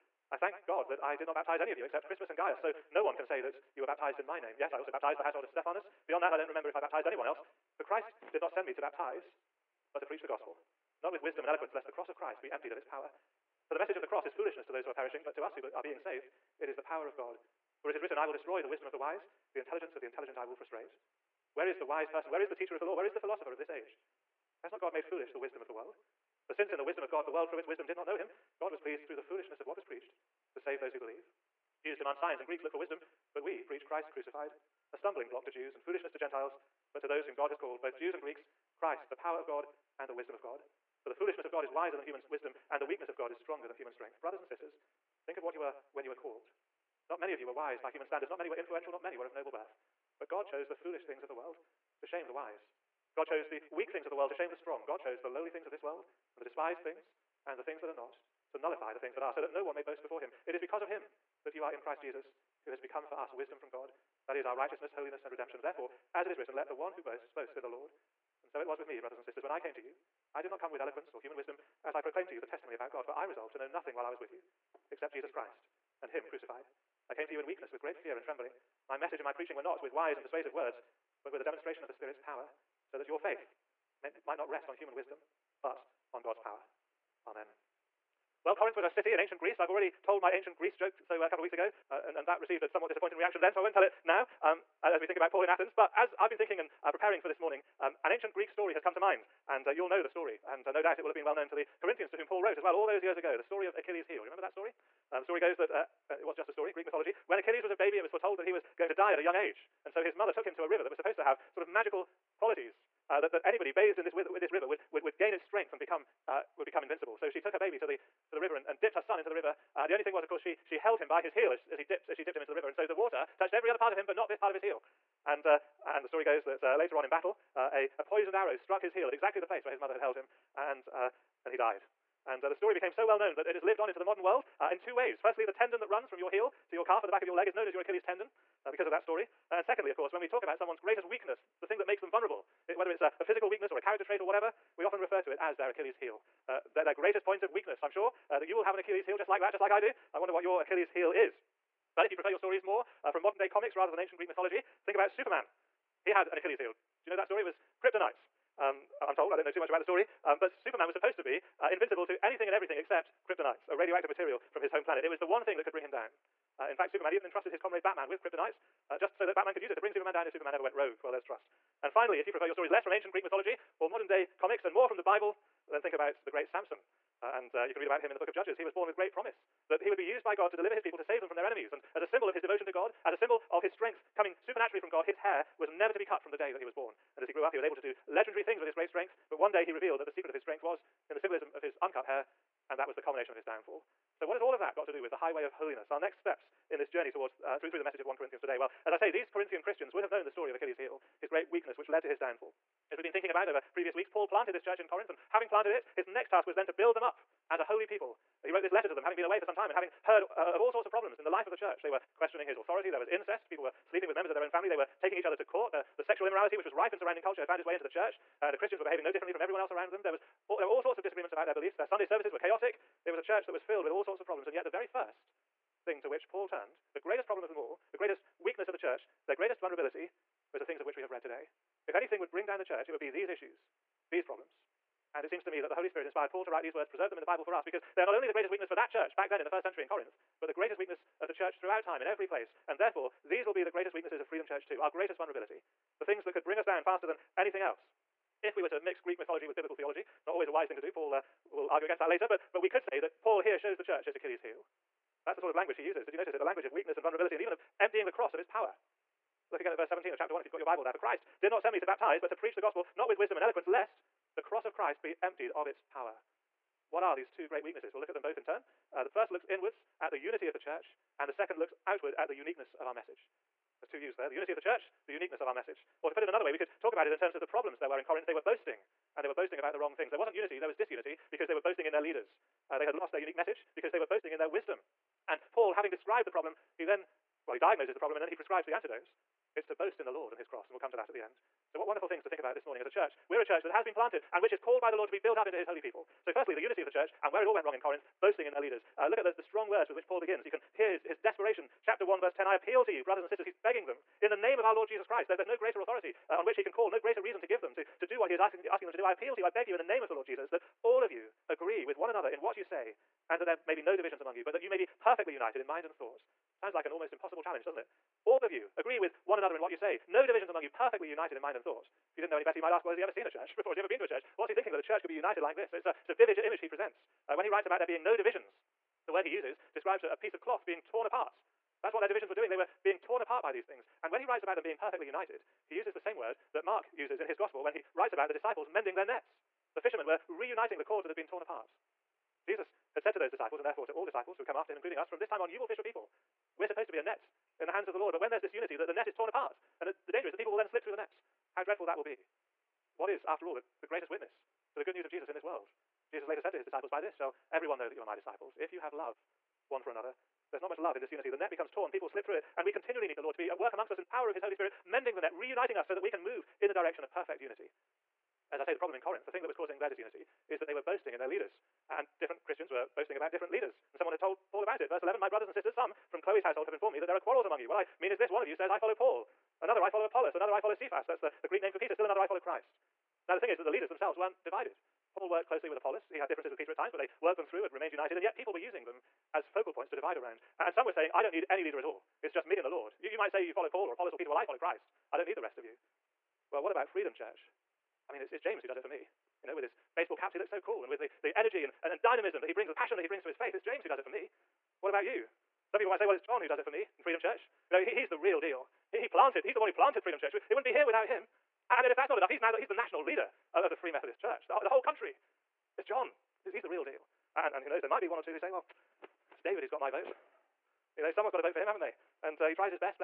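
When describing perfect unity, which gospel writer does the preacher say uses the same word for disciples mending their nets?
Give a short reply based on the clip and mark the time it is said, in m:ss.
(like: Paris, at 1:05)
Mark, at 5:36.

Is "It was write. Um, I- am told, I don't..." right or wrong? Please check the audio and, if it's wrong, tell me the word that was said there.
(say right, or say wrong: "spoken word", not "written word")
wrong: "kryptonite", not "write".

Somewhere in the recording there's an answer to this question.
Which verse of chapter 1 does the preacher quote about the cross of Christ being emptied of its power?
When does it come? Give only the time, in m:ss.
4:19.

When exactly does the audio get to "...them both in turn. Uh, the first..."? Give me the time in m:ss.
4:28.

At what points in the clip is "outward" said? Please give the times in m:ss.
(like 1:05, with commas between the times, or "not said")
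4:31.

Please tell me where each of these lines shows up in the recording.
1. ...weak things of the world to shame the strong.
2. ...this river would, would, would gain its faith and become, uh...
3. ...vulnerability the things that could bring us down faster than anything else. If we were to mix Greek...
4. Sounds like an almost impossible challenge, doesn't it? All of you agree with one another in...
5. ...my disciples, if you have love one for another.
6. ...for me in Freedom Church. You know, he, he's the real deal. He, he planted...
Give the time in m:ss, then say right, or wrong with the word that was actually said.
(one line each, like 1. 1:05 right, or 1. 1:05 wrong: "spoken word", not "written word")
1. 0:53 right
2. 1:54 wrong: "strength", not "faith"
3. 4:05 right
4. 5:16 right
5. 5:58 right
6. 6:46 right.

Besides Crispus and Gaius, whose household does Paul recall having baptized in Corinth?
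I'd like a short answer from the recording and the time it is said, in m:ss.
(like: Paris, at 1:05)
Stephanus, at 0:05.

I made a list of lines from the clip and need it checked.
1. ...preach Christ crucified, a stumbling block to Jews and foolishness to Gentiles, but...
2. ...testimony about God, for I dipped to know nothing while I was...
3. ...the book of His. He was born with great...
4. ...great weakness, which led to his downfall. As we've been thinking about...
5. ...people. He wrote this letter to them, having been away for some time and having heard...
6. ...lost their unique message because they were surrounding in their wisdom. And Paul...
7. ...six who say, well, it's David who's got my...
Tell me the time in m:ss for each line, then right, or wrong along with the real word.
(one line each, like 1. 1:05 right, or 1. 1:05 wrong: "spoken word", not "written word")
1. 0:33 right
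2. 1:12 wrong: "resolved", not "dipped"
3. 2:58 wrong: "Judges", not "His"
4. 3:21 right
5. 3:27 right
6. 4:42 wrong: "boasting", not "surrounding"
7. 6:58 wrong: "two", not "six".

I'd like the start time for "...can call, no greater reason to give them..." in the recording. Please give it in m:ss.
5:06.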